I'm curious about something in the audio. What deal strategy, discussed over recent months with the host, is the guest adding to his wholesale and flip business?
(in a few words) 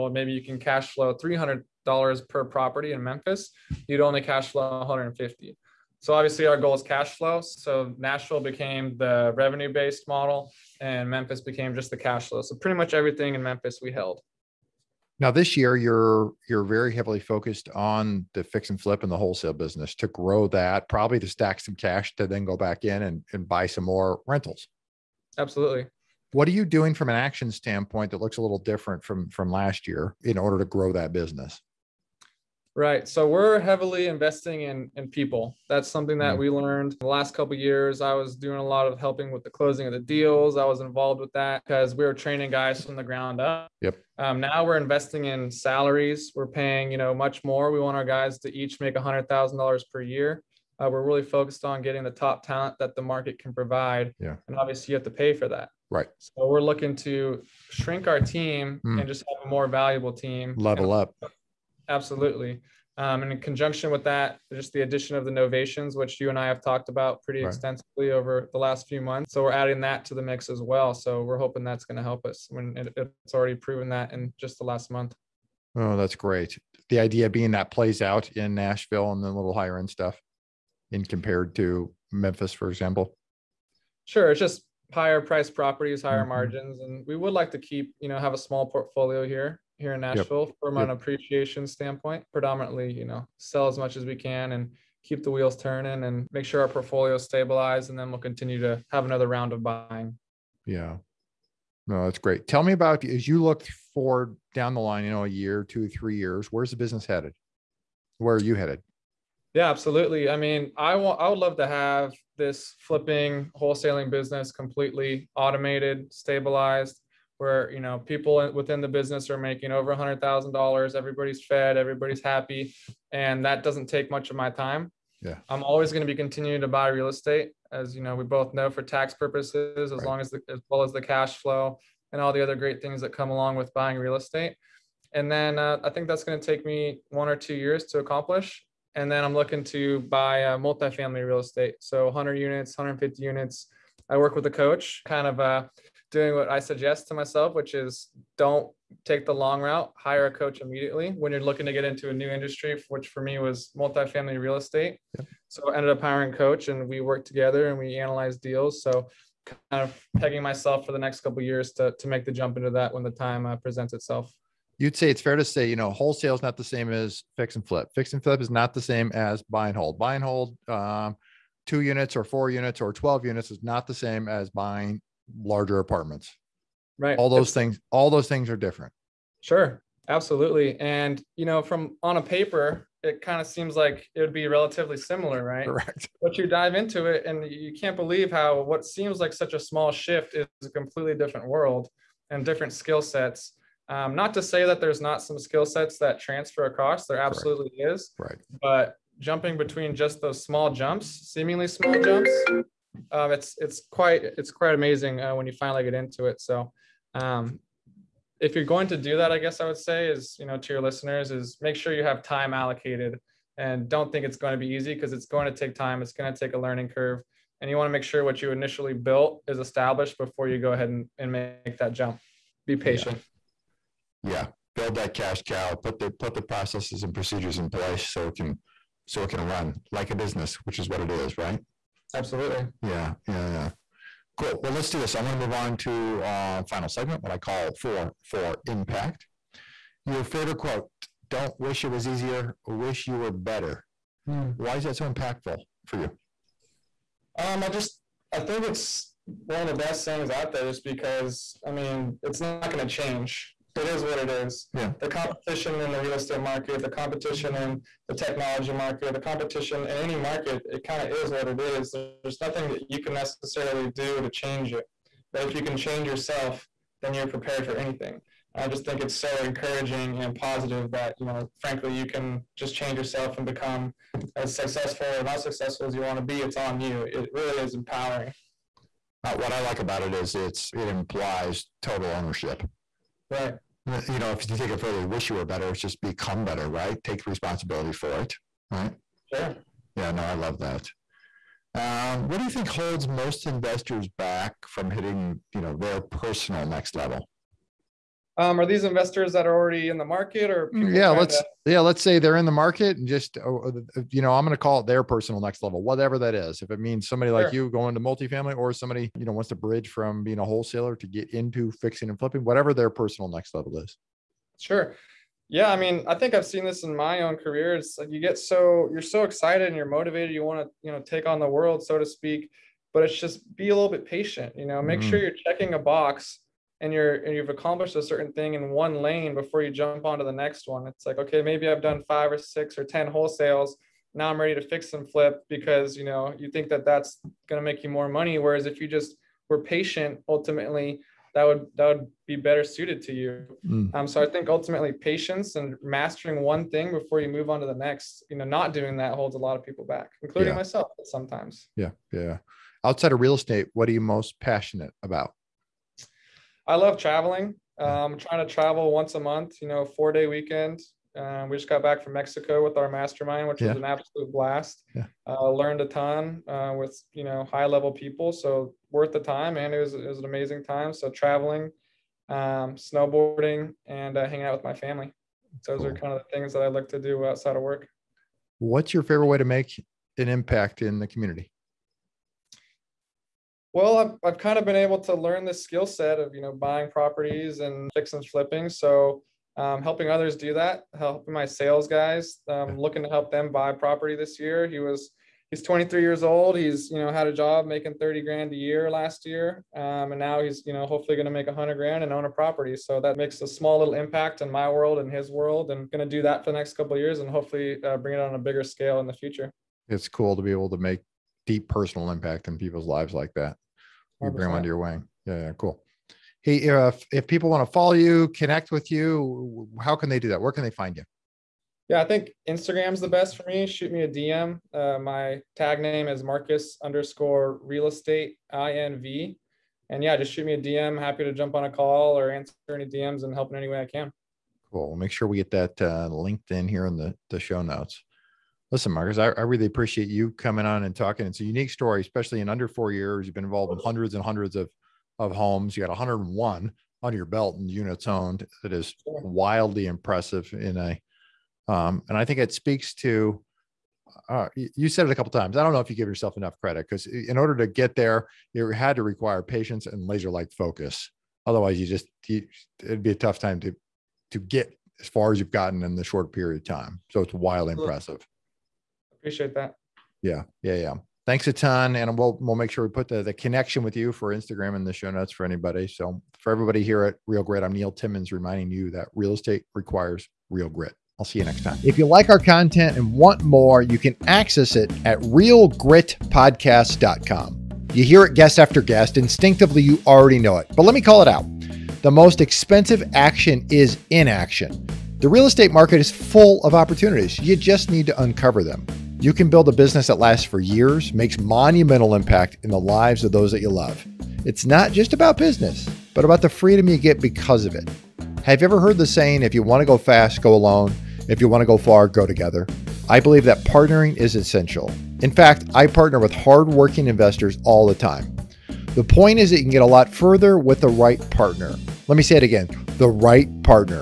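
Novations.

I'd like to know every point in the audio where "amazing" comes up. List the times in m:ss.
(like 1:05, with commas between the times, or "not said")
3:24, 6:10.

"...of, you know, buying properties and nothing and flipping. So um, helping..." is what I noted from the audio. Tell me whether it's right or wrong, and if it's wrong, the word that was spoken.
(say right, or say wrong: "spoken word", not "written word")
wrong: "fixing", not "nothing".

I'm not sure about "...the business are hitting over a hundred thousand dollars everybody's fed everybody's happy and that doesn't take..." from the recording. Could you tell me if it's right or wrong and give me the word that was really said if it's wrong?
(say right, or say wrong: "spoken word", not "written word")
wrong: "making", not "hitting".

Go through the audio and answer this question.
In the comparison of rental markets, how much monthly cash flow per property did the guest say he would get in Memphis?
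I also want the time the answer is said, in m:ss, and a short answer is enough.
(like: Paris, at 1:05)
150, at 0:03.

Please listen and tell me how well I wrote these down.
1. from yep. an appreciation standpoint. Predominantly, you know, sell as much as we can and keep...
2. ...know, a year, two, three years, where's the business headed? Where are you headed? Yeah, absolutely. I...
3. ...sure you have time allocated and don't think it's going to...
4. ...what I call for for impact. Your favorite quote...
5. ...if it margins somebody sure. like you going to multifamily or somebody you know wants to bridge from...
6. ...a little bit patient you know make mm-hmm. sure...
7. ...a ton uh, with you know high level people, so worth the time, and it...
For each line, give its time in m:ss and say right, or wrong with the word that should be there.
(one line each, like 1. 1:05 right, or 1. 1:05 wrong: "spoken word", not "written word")
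1. 1:30 right
2. 1:45 right
3. 3:31 right
4. 3:57 right
5. 5:06 wrong: "means", not "margins"
6. 5:23 right
7. 6:05 right.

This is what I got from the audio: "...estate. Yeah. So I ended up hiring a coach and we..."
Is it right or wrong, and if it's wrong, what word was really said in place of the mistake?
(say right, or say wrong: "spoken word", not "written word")
right.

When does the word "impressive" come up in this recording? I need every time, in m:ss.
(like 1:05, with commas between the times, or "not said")
7:29, 7:47.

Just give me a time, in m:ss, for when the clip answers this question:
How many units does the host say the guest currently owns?
7:25.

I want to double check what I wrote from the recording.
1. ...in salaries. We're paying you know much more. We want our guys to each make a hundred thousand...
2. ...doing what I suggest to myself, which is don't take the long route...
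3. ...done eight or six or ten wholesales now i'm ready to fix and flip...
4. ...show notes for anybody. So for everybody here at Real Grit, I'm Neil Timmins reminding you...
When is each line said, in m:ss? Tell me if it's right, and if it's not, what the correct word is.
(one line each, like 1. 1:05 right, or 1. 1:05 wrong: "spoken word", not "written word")
1. 0:45 right
2. 2:26 right
3. 5:31 wrong: "five", not "eight"
4. 7:54 right.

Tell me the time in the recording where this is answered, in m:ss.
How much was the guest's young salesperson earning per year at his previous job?
6:37.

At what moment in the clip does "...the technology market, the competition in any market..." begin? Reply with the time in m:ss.
4:18.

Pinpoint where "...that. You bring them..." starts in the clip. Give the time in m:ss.
6:53.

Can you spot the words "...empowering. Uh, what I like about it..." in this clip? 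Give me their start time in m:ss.
4:37.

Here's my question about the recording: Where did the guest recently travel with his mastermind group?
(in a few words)
Mexico.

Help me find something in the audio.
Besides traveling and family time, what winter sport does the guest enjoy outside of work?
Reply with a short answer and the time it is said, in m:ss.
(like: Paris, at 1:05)
Snowboarding, at 6:12.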